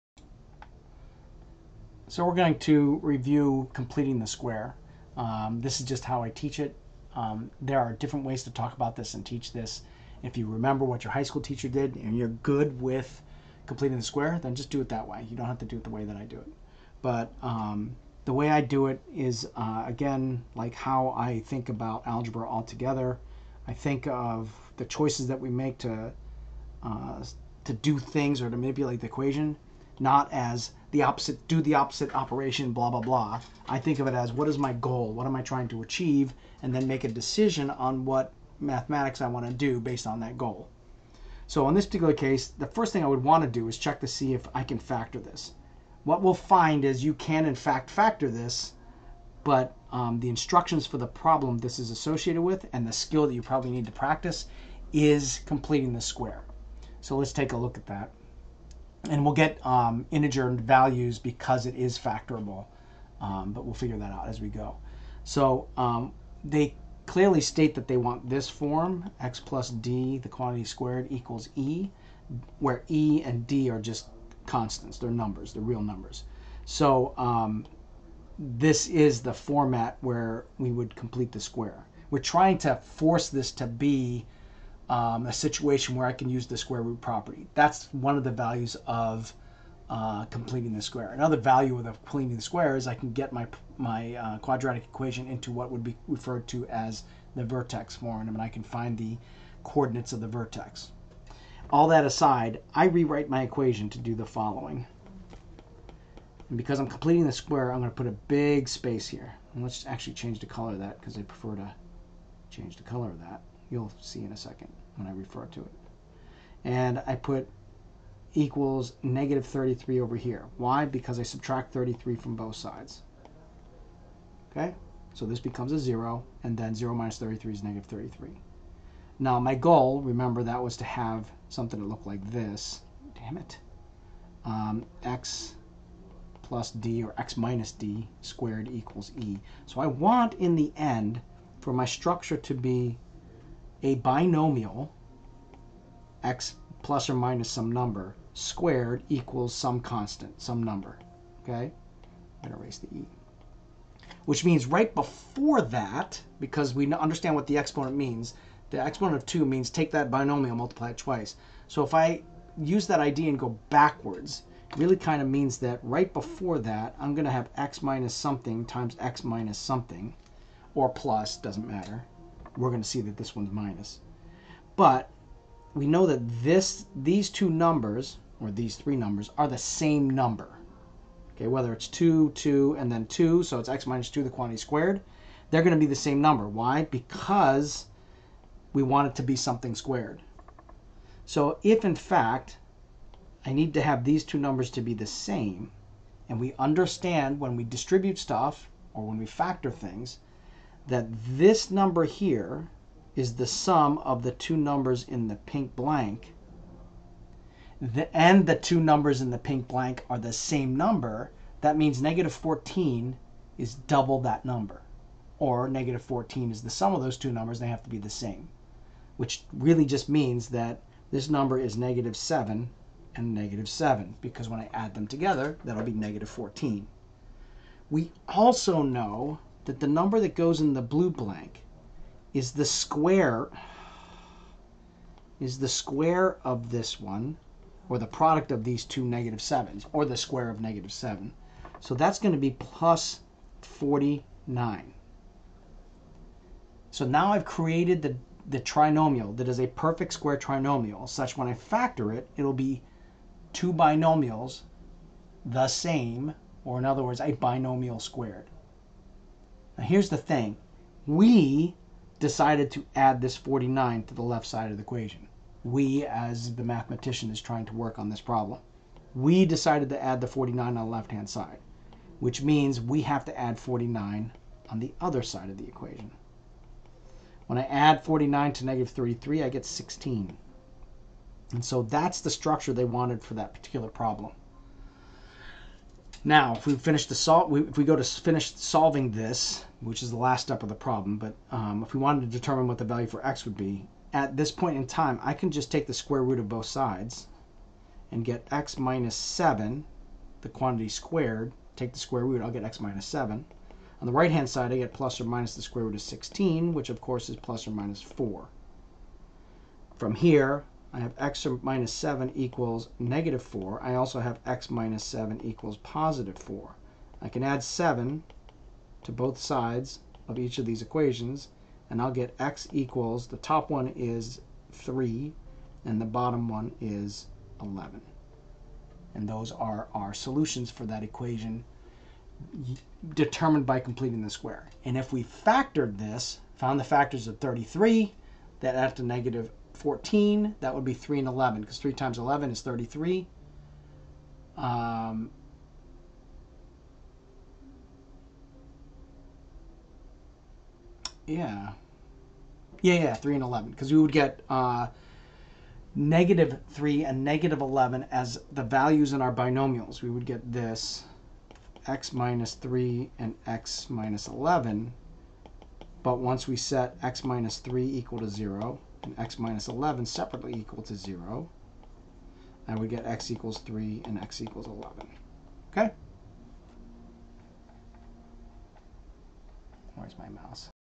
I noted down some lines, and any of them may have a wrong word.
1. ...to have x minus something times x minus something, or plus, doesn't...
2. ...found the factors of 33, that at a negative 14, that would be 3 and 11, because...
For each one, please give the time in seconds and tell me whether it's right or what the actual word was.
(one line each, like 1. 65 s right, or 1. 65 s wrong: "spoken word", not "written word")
1. 167 s right
2. 336 s right.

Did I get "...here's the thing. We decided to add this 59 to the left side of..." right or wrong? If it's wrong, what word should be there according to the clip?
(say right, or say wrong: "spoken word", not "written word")
wrong: "49", not "59".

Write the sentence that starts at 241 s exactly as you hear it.
So that's going to be plus 49.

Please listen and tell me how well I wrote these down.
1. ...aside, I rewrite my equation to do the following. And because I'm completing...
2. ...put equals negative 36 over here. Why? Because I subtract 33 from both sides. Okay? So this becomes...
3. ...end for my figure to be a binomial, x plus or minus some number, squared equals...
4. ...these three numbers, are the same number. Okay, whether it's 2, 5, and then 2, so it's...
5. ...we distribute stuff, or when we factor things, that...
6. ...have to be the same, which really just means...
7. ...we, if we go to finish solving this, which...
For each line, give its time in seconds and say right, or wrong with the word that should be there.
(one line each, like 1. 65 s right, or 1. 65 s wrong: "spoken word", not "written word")
1. 102 s right
2. 117 s wrong: "33", not "36"
3. 140 s wrong: "structure", not "figure"
4. 178 s wrong: "2", not "5"
5. 197 s right
6. 217 s right
7. 287 s right.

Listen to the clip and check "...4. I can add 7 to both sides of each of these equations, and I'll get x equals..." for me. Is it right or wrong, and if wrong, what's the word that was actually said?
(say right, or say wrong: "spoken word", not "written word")
right.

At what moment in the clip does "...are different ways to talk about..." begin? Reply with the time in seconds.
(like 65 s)
7 s.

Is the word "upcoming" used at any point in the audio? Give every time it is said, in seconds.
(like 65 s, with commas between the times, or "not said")
not said.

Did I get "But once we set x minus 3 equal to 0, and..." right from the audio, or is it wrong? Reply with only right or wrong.
right.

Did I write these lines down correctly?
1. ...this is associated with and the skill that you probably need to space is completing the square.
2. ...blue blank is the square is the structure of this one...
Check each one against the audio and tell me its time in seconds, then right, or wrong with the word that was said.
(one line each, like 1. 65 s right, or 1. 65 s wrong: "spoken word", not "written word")
1. 51 s wrong: "practice", not "space"
2. 230 s wrong: "square", not "structure".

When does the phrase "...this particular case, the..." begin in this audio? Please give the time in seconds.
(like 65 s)
41 s.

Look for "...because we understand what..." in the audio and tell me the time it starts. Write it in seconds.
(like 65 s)
156 s.